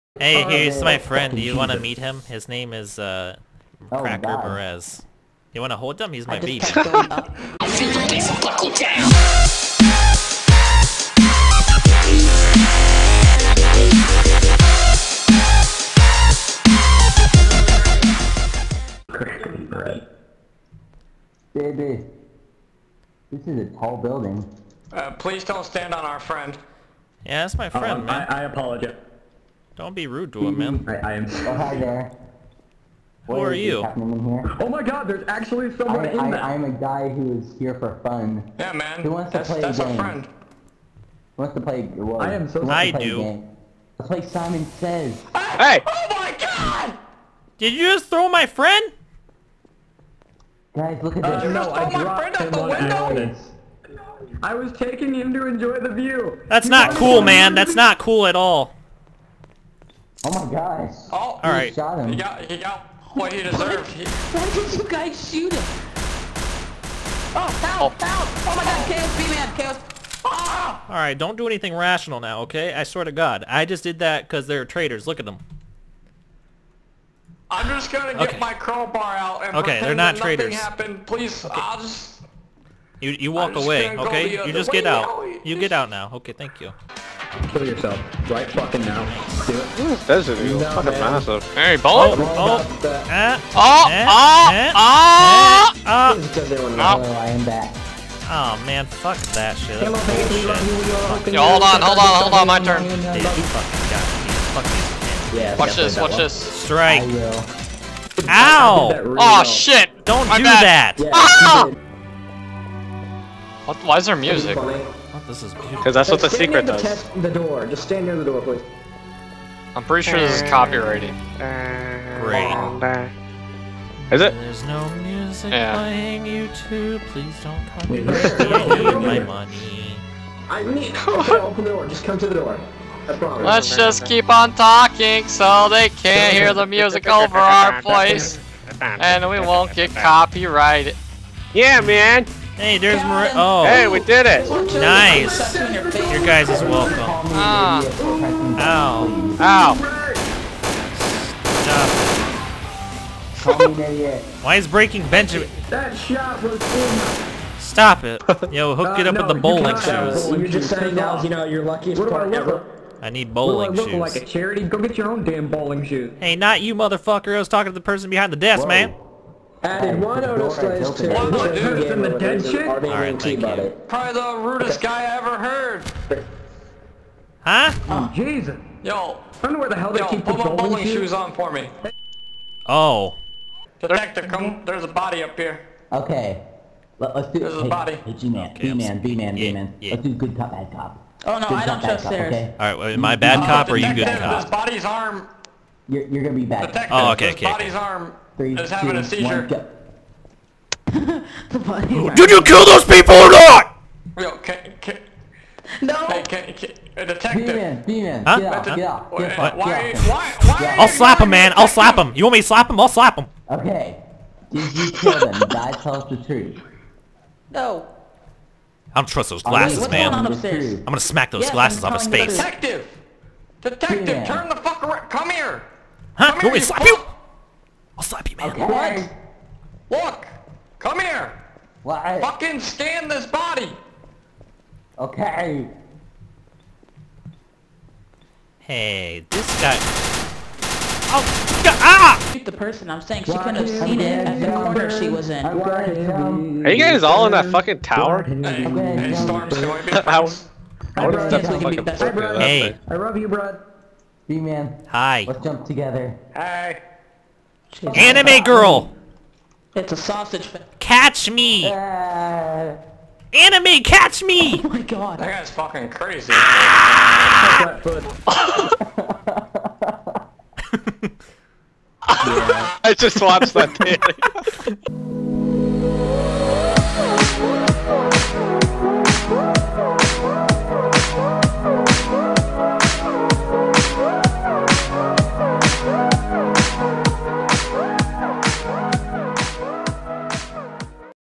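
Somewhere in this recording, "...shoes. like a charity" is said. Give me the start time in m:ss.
2:43.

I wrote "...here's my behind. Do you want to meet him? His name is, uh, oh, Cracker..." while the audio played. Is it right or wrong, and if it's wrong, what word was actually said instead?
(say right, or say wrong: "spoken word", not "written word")
wrong: "friend", not "behind".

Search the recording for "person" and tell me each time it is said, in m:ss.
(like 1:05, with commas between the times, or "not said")
2:47, 4:02.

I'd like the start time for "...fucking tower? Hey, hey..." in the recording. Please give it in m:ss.
4:07.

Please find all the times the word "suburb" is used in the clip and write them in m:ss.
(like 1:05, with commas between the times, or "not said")
not said.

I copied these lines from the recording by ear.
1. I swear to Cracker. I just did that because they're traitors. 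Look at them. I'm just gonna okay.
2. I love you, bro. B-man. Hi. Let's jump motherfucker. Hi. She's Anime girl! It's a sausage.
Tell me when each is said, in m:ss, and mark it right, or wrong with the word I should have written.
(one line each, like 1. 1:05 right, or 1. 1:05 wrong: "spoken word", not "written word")
1. 1:12 wrong: "God", not "Cracker"
2. 4:12 wrong: "together", not "motherfucker".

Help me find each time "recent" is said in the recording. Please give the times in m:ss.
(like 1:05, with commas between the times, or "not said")
not said.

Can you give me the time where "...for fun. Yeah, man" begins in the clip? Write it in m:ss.
0:37.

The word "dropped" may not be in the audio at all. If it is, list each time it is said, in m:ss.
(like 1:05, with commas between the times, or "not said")
0:51.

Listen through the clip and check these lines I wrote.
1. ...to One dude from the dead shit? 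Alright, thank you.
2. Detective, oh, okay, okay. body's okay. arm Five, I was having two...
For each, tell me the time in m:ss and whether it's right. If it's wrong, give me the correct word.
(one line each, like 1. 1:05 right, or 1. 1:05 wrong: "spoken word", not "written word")
1. 2:50 right
2. 3:16 wrong: "Three", not "Five".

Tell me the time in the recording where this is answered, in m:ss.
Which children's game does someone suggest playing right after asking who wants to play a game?
0:44.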